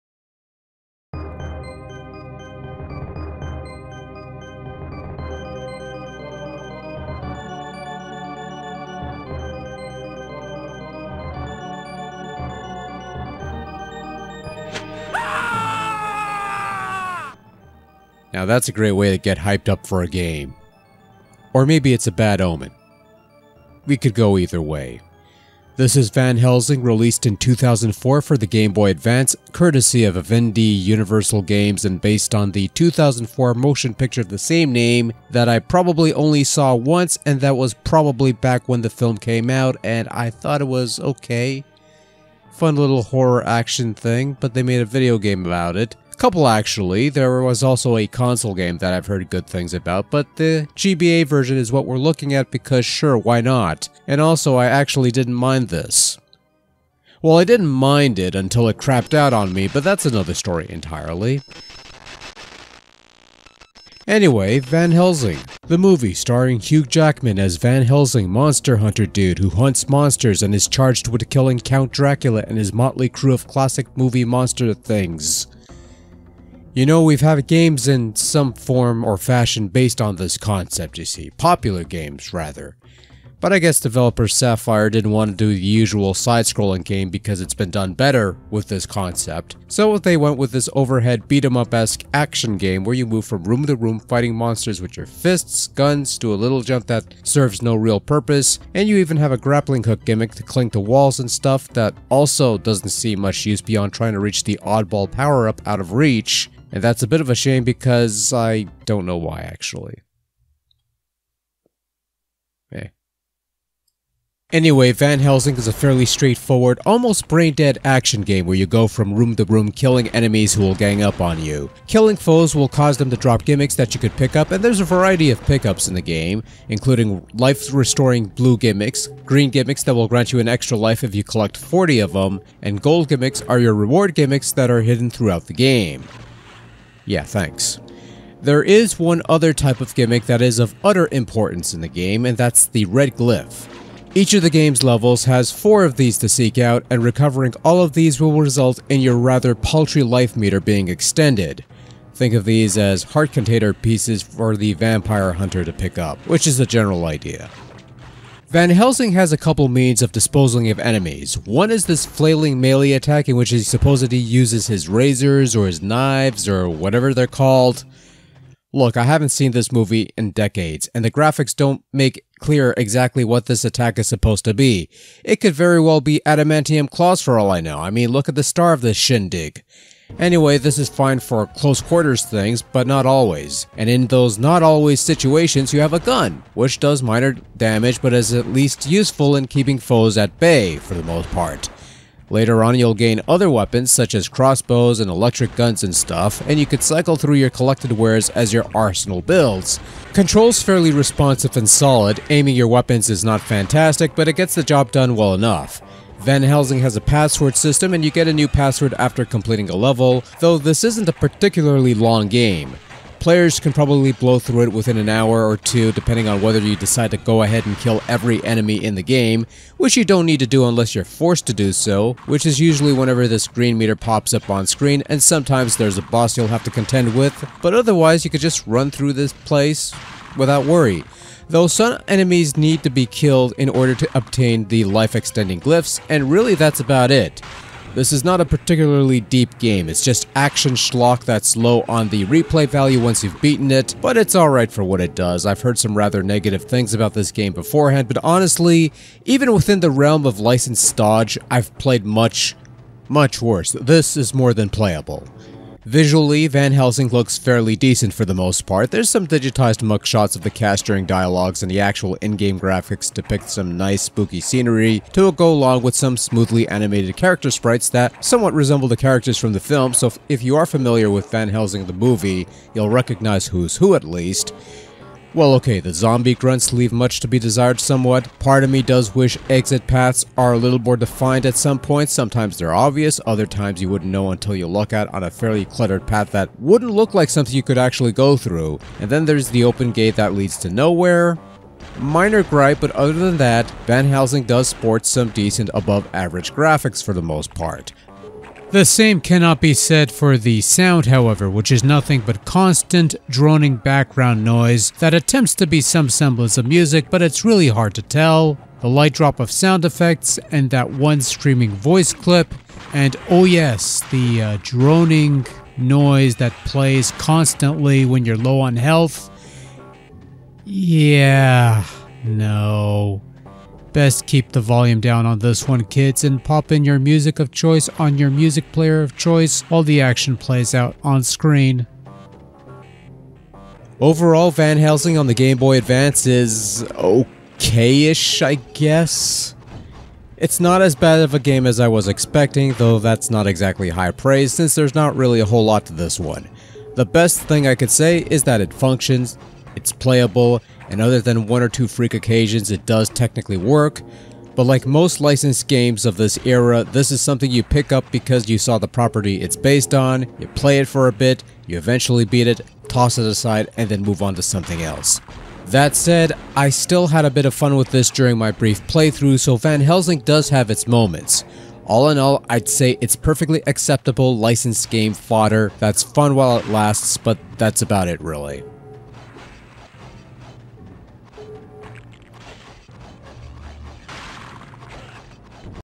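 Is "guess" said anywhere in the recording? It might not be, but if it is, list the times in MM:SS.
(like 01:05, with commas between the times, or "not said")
01:23, 05:38.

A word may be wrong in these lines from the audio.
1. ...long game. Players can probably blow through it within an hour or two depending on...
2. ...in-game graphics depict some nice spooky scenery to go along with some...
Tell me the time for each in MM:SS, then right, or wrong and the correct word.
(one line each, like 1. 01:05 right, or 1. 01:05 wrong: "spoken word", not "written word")
1. 03:31 right
2. 04:22 right.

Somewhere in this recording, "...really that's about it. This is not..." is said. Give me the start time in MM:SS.
03:56.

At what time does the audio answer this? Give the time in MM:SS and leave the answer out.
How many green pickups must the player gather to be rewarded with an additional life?
02:11.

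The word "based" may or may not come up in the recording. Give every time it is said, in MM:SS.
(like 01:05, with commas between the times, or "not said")
00:31, 01:19, 05:59.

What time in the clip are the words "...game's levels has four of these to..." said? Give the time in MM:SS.
02:24.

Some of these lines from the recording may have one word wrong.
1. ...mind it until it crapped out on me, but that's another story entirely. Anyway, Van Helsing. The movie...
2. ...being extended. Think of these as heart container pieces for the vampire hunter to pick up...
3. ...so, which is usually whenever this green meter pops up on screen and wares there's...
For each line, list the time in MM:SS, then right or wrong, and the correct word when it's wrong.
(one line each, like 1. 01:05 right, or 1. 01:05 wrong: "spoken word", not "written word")
1. 00:57 right
2. 02:30 right
3. 03:41 wrong: "sometimes", not "wares".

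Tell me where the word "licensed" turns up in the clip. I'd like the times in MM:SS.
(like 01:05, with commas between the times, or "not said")
04:10, 05:55, 06:14.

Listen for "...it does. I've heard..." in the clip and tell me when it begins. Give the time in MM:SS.
04:05.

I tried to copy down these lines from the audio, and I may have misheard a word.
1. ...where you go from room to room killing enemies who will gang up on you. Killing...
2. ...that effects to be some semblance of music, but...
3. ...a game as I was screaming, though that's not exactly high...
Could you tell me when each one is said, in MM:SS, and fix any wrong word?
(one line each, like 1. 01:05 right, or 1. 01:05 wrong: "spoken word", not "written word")
1. 01:58 right
2. 05:04 wrong: "attempts", not "effects"
3. 05:41 wrong: "expecting", not "screaming".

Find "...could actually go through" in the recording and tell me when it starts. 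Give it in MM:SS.
04:47.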